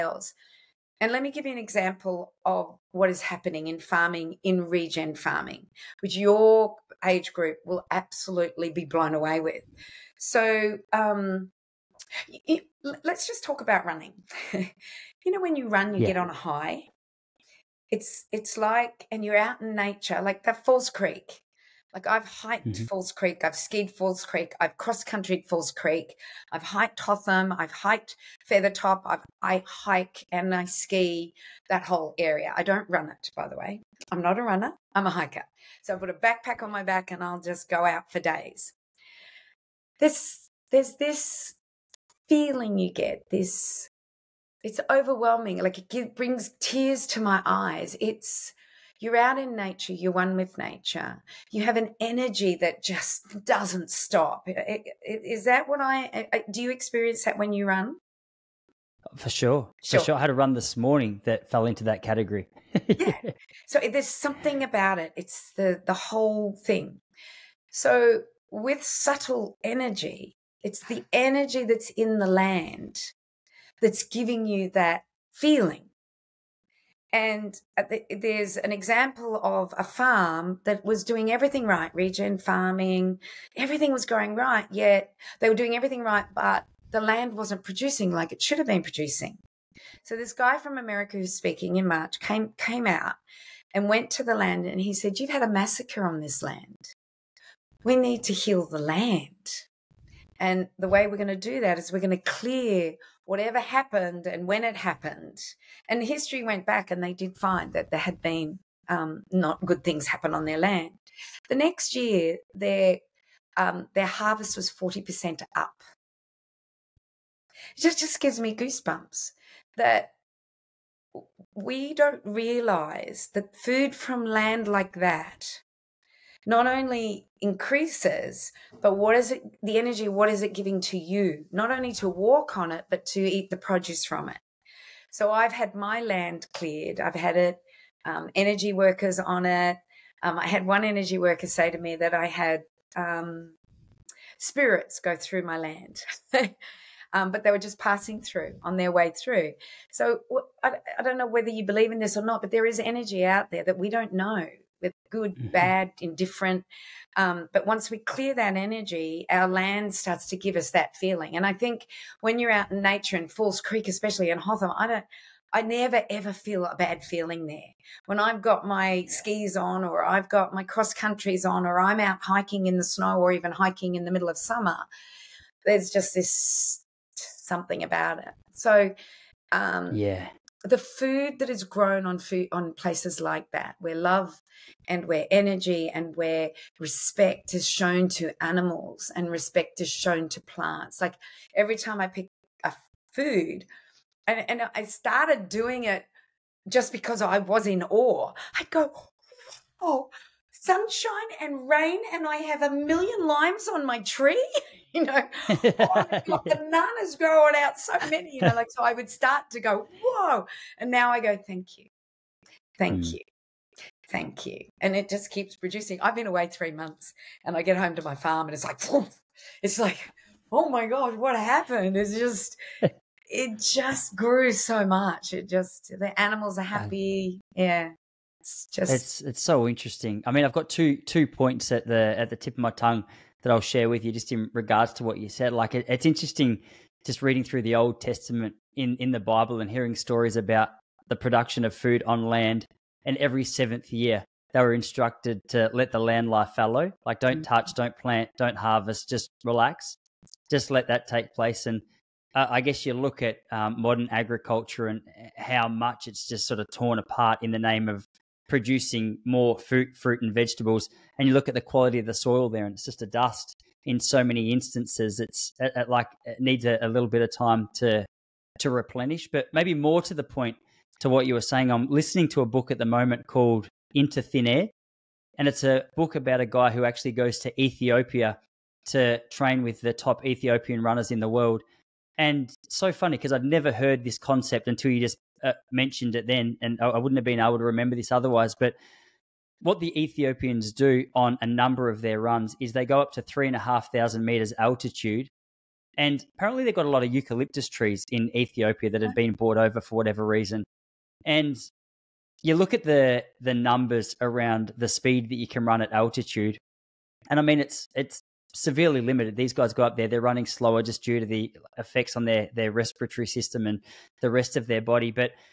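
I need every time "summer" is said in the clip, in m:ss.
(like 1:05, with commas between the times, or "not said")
2:54.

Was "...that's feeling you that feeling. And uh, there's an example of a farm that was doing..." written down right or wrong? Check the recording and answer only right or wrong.
wrong.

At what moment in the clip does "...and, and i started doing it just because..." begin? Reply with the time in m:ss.
3:14.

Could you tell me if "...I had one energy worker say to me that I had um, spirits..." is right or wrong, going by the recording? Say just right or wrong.
right.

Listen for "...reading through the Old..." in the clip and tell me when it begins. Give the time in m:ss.
3:57.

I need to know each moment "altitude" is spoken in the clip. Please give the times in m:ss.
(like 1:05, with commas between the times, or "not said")
4:54, 5:05.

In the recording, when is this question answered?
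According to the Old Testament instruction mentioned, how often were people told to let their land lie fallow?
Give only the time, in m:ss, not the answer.
4:03.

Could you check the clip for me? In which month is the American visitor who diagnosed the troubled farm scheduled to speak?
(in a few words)
March.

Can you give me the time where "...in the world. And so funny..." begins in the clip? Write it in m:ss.
4:41.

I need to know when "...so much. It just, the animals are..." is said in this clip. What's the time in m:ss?
3:44.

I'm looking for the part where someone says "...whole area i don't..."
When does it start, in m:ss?
0:31.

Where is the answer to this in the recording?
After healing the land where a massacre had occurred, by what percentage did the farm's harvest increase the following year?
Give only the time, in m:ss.
1:54.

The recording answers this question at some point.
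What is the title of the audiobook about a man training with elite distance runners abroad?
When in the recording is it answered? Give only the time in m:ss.
4:33.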